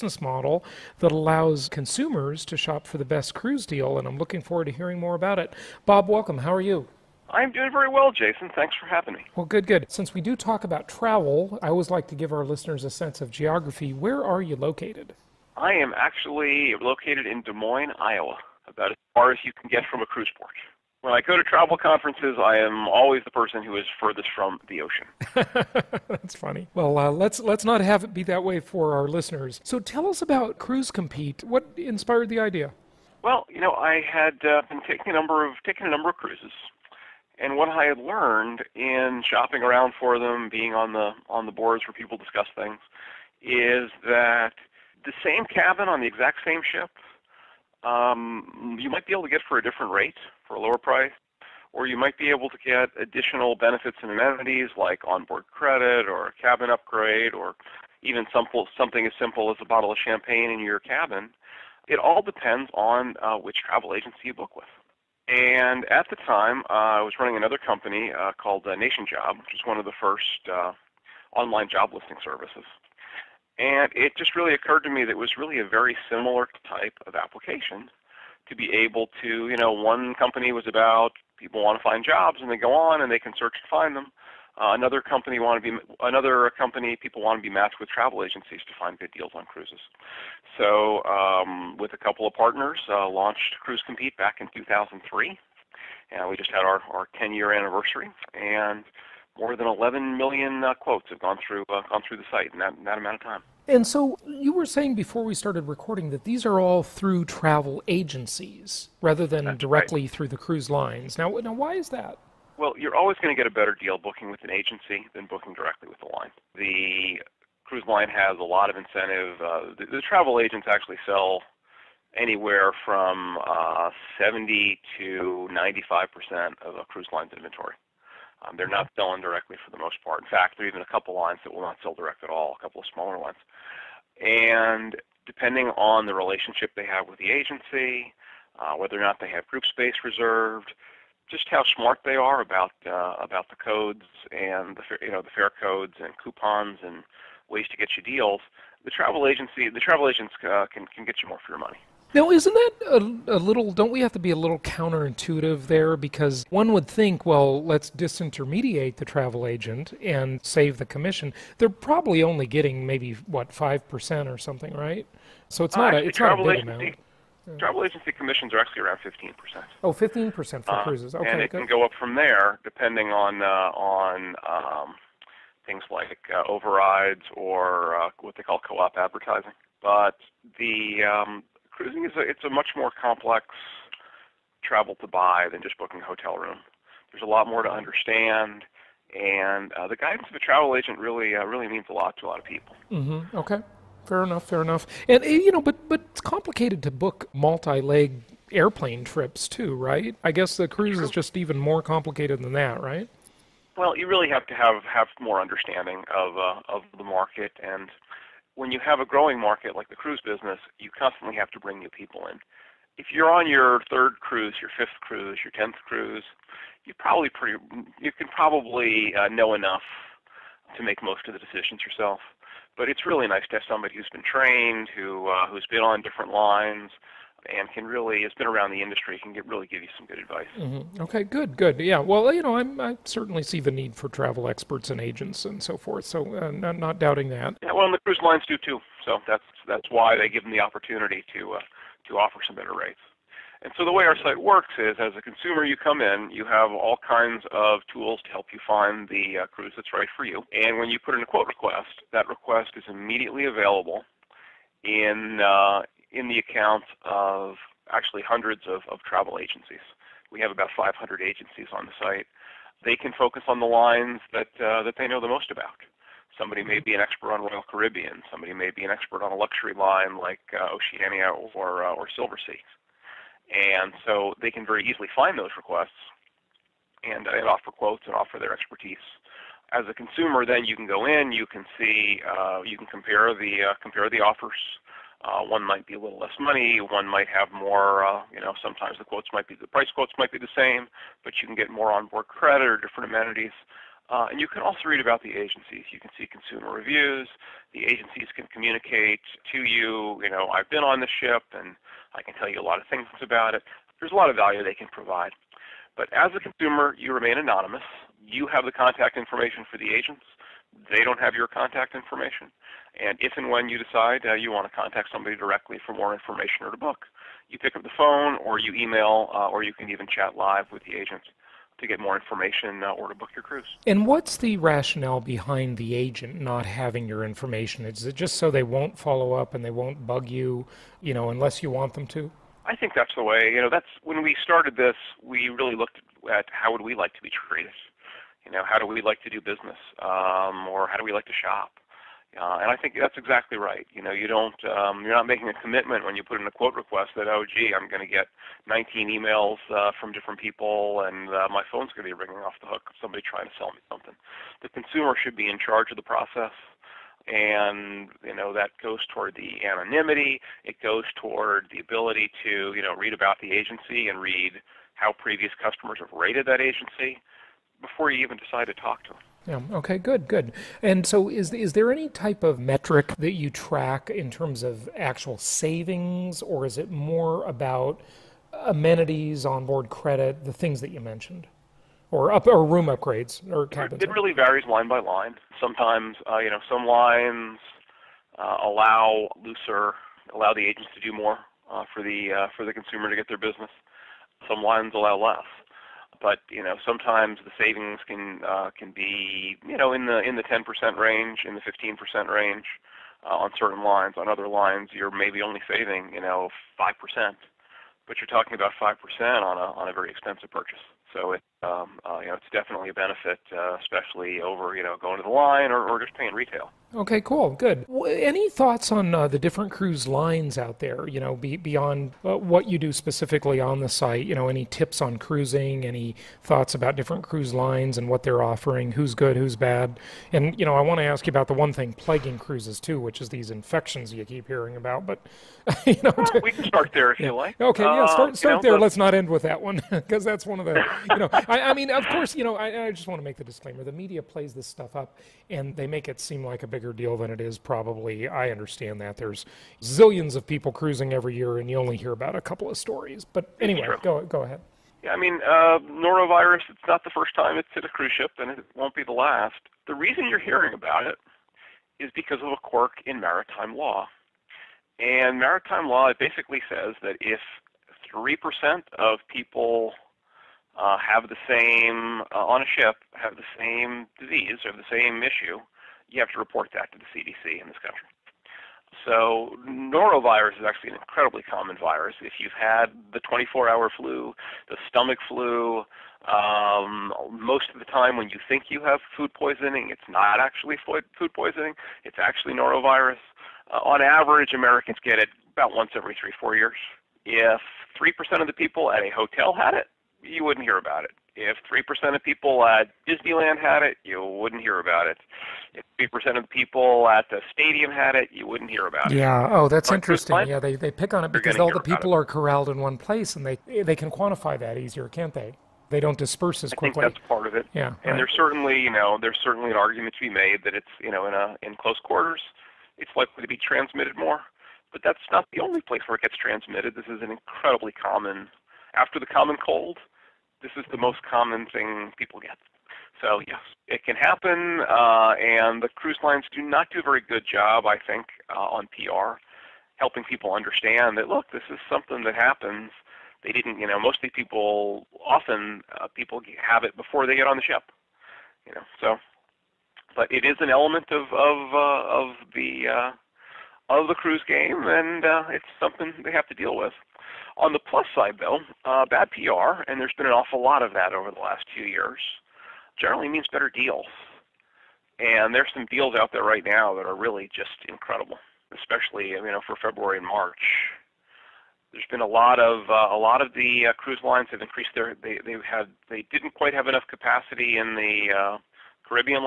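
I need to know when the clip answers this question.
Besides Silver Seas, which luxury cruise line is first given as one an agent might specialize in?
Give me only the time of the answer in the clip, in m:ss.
4:30.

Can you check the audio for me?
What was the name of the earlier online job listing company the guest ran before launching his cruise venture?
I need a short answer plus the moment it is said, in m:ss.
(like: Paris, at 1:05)
NationJob, at 1:08.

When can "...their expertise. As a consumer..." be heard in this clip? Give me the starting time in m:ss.
4:38.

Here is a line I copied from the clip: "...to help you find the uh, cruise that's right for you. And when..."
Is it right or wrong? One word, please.
right.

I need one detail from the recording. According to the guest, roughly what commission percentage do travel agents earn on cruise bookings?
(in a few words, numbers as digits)
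15%.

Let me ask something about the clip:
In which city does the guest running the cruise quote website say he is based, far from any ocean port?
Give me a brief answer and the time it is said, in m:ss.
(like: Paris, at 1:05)
Des Moines, Iowa, at 0:17.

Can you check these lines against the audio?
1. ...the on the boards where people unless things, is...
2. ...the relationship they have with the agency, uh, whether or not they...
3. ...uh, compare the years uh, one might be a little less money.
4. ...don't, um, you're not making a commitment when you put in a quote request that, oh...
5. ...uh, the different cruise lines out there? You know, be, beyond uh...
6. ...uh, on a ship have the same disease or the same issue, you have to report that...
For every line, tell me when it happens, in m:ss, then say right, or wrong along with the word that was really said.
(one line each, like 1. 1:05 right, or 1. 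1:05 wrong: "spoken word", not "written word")
1. 0:40 wrong: "discuss", not "unless"
2. 2:16 right
3. 4:43 wrong: "offers", not "years"
4. 5:44 right
5. 6:59 right
6. 7:52 right.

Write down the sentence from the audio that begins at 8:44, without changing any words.
But that's not the only place where it gets transmitted.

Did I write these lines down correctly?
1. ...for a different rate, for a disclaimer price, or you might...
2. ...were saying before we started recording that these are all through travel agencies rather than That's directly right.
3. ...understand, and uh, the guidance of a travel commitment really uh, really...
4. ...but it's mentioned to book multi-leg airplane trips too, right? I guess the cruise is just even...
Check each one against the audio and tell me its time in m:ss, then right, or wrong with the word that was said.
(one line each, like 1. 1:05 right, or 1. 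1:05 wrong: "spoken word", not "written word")
1. 0:49 wrong: "lower", not "disclaimer"
2. 1:44 right
3. 3:07 wrong: "agent", not "commitment"
4. 3:15 wrong: "complicated", not "mentioned".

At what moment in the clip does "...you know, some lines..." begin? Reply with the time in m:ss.
6:26.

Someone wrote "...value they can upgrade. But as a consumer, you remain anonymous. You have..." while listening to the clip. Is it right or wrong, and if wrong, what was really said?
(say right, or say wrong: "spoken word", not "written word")
wrong: "provide", not "upgrade".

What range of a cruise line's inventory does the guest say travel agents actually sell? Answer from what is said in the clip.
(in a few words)
70 to 95 percent.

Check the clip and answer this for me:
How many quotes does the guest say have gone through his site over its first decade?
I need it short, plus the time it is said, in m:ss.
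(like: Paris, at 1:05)
11 million, at 1:39.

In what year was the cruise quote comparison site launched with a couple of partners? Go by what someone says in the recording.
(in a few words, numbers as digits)
2003.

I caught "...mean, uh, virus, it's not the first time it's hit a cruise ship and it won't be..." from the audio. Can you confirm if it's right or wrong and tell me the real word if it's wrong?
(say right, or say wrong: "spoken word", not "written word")
wrong: "norovirus", not "virus".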